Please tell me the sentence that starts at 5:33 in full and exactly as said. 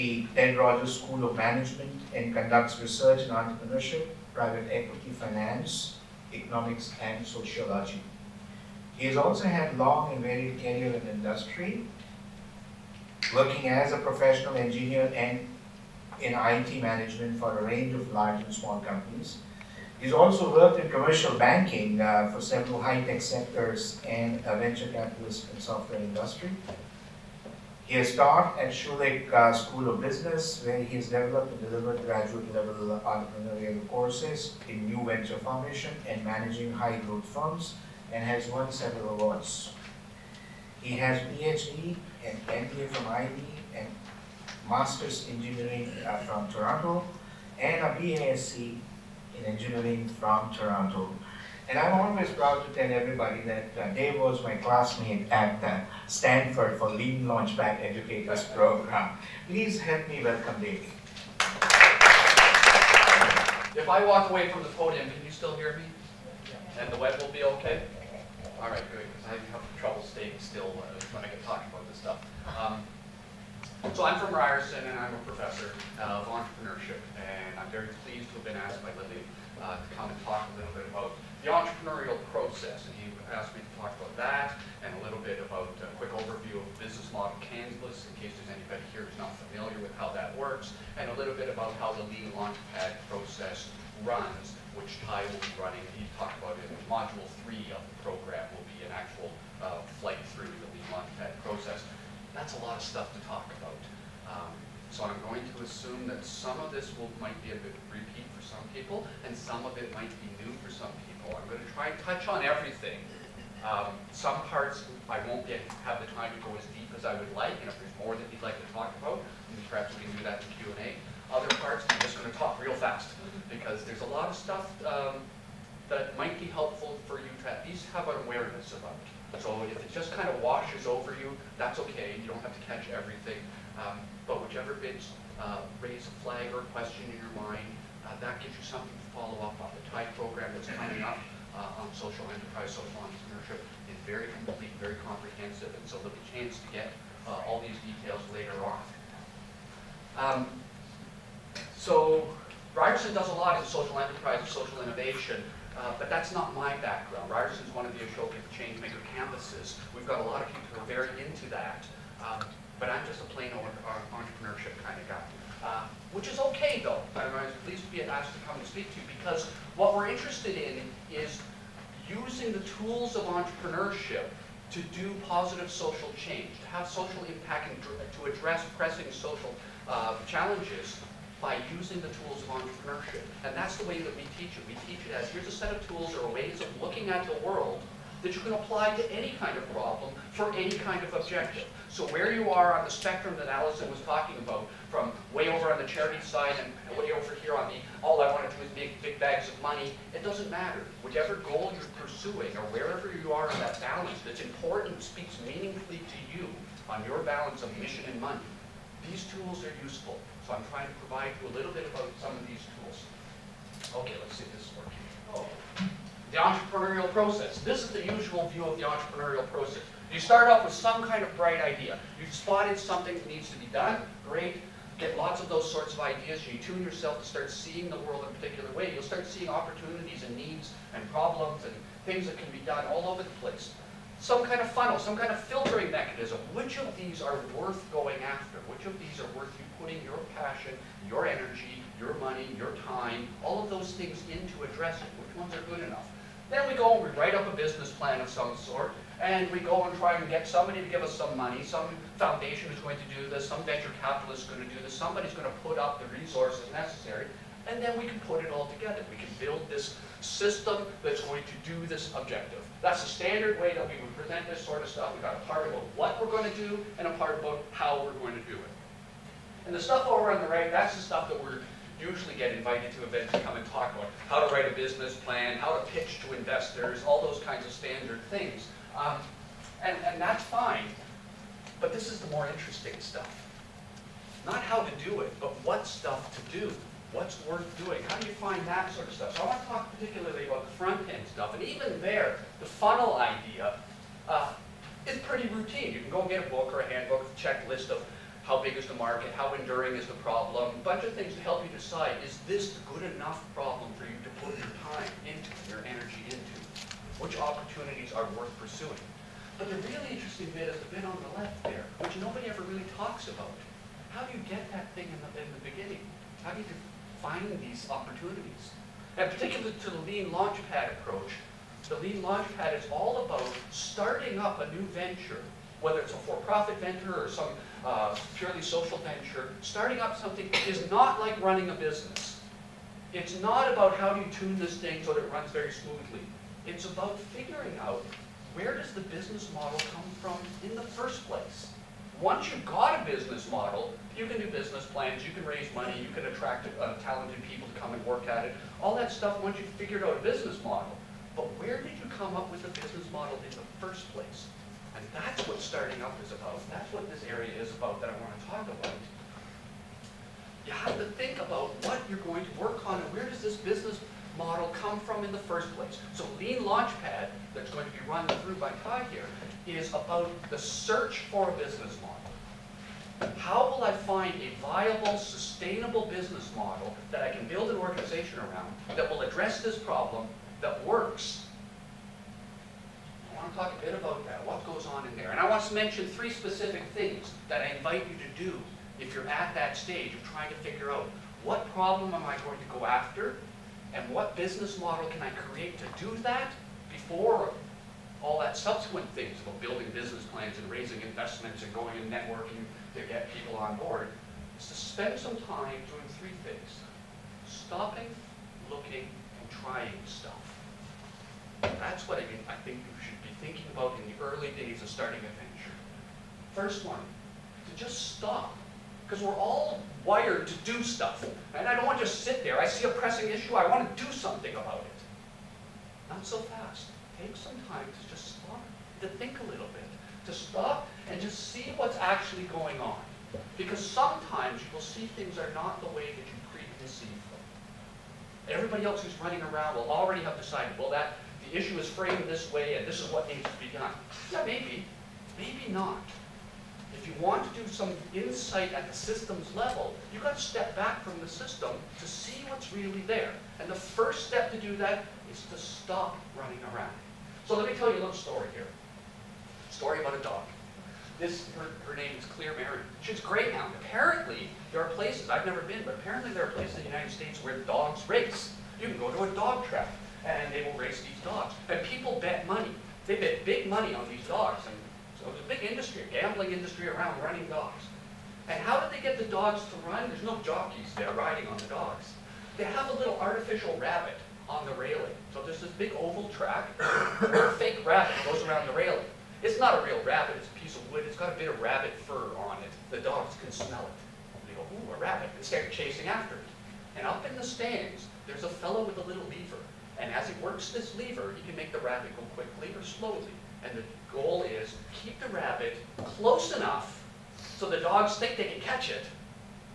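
It's not about how do you tune this thing so that it runs very smoothly.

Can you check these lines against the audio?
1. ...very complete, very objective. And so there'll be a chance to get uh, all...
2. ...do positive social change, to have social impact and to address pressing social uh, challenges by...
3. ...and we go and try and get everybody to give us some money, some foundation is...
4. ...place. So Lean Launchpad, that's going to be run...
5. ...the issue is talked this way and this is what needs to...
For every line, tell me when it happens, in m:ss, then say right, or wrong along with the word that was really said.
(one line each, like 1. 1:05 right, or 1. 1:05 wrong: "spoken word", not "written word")
1. 2:24 wrong: "comprehensive", not "objective"
2. 2:54 right
3. 4:09 wrong: "somebody", not "everybody"
4. 6:05 right
5. 7:21 wrong: "framed", not "talked".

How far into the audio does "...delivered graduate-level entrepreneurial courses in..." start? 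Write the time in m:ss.
0:31.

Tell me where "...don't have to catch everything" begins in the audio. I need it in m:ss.
2:12.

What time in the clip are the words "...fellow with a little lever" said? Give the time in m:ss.
8:18.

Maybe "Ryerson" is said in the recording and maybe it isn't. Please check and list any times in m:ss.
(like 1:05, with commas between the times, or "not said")
1:14, 2:32, 2:37.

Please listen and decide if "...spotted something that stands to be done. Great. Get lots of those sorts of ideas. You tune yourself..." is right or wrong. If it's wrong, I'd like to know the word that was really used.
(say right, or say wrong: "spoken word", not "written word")
wrong: "needs", not "stands".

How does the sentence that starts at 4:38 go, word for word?
Um, and, and that's fine, but this is the more interesting stuff.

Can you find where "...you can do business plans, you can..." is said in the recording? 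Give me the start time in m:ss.
5:44.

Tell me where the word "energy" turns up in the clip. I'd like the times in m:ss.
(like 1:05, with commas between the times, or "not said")
4:01, 5:05.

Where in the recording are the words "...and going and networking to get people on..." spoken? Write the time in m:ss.
6:41.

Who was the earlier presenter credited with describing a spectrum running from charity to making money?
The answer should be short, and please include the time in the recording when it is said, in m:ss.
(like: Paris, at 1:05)
Allison, at 3:13.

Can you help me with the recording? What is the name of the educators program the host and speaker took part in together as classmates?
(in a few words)
Lean Launchpad Educators program.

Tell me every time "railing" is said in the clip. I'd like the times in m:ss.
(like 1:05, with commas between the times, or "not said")
8:04, 8:08.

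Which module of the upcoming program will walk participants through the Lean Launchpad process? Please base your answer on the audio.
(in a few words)
Module 3.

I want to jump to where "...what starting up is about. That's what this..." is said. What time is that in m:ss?
5:55.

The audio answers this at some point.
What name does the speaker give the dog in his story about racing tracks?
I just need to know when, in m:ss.
7:42.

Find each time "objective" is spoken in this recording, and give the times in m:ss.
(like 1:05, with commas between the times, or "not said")
3:11, 4:22.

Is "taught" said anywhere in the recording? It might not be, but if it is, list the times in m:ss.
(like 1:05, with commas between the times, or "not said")
0:28.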